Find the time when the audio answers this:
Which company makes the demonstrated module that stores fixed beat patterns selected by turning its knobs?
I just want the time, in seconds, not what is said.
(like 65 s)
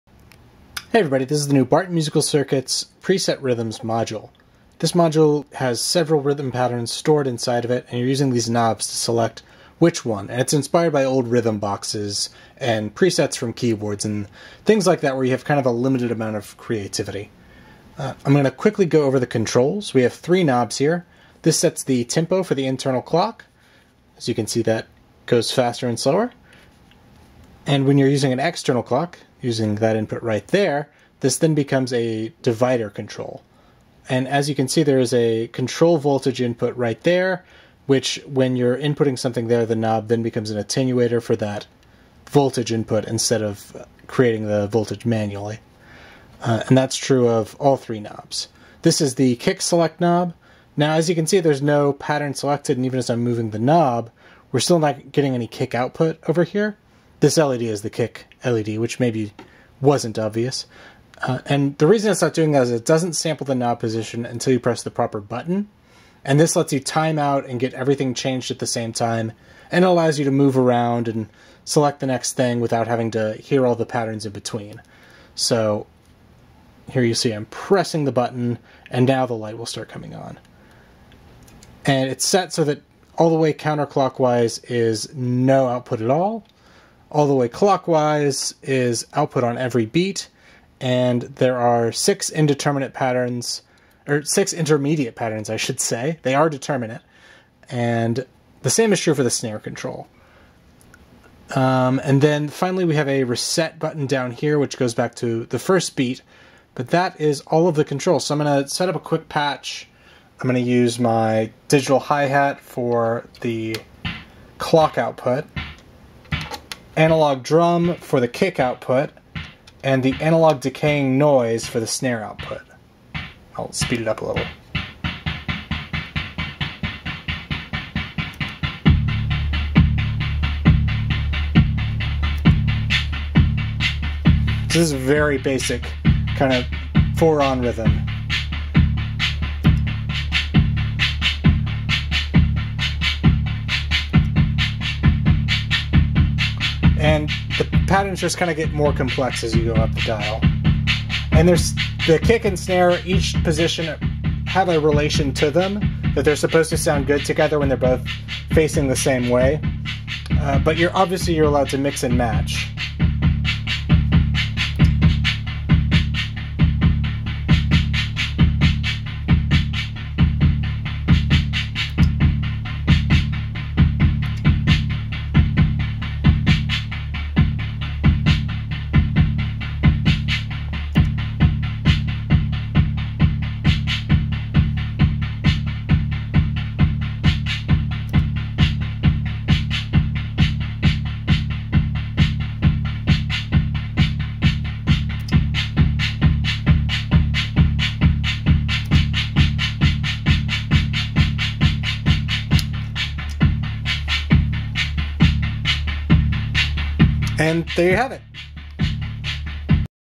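1 s.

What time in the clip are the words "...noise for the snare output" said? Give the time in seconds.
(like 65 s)
121 s.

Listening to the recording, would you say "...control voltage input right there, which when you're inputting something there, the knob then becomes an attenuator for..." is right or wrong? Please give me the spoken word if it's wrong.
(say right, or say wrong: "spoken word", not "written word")
right.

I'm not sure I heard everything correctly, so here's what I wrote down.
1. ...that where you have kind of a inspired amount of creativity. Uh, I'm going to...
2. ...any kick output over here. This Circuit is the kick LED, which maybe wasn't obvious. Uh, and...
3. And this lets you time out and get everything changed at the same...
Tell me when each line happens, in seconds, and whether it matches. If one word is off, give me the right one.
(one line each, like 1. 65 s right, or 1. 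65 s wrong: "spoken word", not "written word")
1. 14 s wrong: "limited", not "inspired"
2. 55 s wrong: "LED", not "Circuit"
3. 66 s right.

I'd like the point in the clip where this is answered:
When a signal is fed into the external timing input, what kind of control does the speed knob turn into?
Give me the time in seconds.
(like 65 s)
32 s.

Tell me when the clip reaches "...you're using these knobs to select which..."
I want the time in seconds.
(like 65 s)
7 s.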